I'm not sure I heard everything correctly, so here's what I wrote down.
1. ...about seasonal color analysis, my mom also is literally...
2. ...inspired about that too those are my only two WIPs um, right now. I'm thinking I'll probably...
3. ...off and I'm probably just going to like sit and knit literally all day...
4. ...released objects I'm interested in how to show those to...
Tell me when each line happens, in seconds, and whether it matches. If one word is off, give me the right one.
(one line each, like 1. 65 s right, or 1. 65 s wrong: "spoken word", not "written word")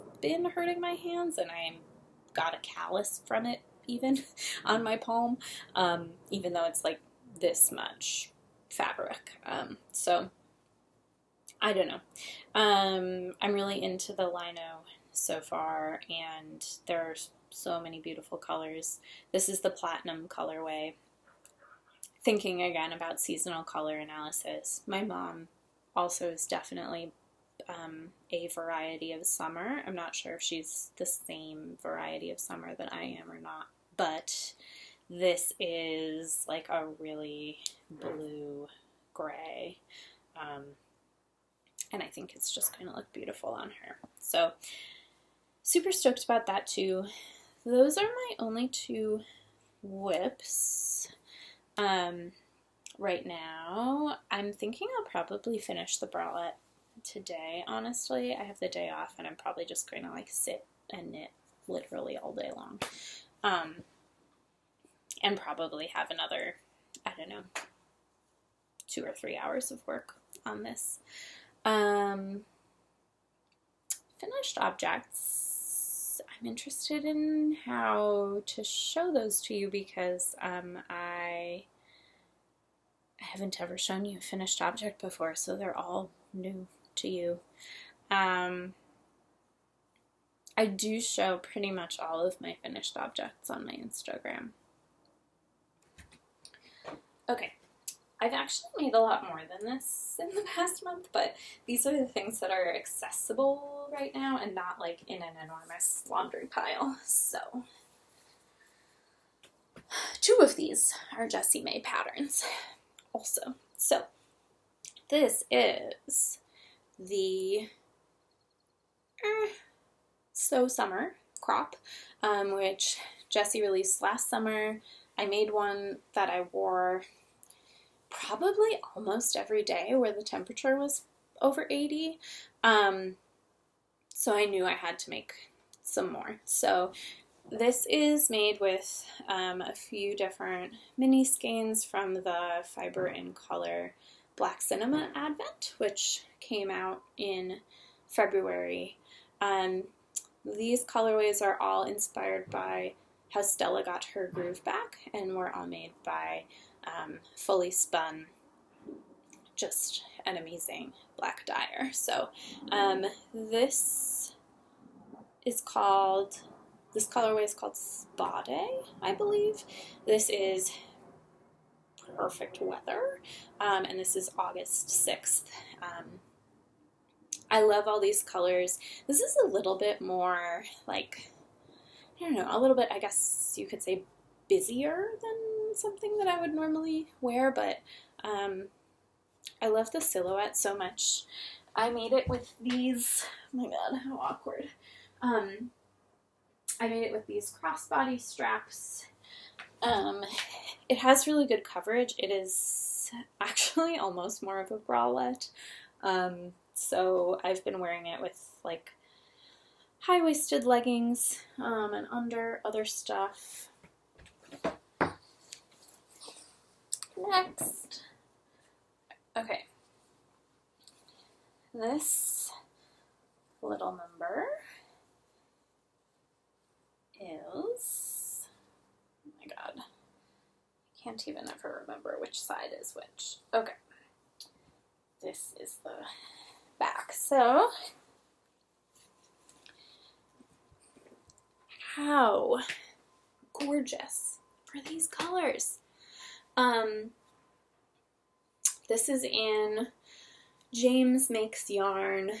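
1. 22 s wrong: "definitely", not "literally"
2. 45 s wrong: "stoked", not "inspired"
3. 58 s right
4. 74 s wrong: "finished", not "released".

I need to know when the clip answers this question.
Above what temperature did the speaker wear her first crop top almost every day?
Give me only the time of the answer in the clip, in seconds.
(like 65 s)
131 s.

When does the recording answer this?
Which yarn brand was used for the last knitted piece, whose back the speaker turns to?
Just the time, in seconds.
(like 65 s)
250 s.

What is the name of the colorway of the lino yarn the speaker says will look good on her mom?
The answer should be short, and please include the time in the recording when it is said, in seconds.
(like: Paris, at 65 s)
Platinum, at 19 s.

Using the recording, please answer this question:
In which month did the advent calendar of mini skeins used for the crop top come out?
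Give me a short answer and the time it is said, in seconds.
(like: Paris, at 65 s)
February, at 148 s.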